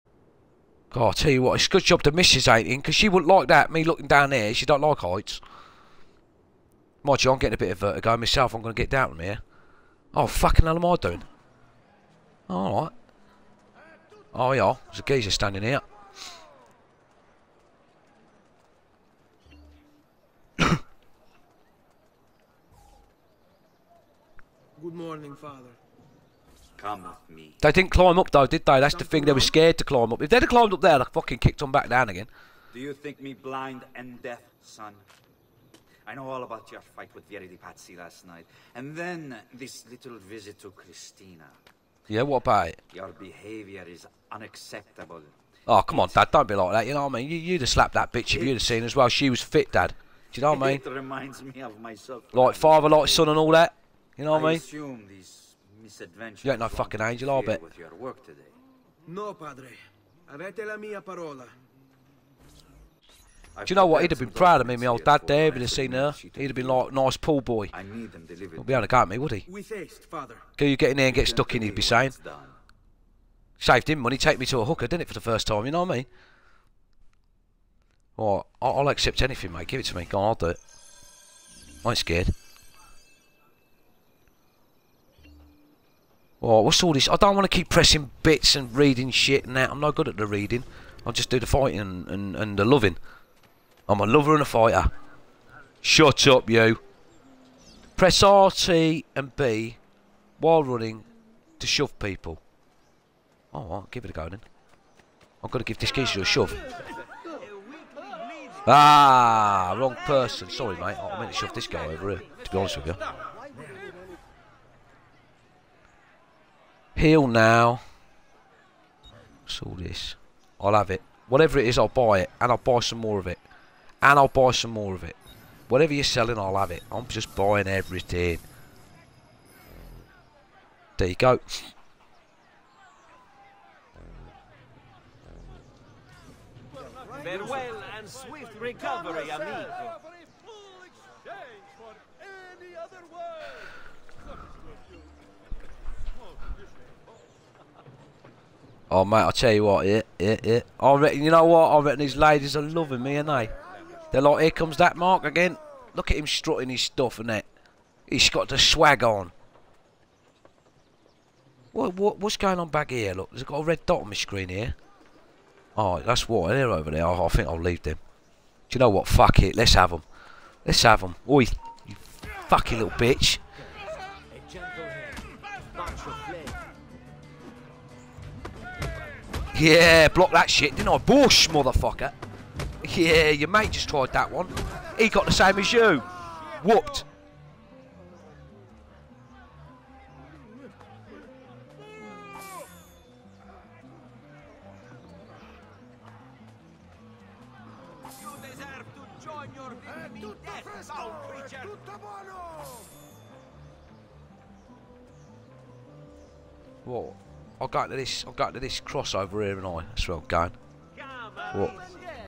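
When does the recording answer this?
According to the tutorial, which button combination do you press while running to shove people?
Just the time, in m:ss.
1:38.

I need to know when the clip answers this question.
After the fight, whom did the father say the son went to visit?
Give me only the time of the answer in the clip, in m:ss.
0:40.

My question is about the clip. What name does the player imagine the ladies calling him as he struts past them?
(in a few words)
Mark.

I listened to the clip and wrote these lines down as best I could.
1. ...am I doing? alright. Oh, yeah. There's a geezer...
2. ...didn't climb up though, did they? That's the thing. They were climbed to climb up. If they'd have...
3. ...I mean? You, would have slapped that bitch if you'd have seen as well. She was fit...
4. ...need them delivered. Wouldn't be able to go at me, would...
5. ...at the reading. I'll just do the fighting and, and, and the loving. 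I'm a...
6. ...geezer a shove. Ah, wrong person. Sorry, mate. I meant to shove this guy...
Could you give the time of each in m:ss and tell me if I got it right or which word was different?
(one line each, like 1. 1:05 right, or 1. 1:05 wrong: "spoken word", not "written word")
1. 0:10 right
2. 0:27 wrong: "scared", not "climbed"
3. 0:47 right
4. 1:07 right
5. 1:30 right
6. 1:45 right.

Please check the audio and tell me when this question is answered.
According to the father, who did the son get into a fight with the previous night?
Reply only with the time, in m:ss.
0:37.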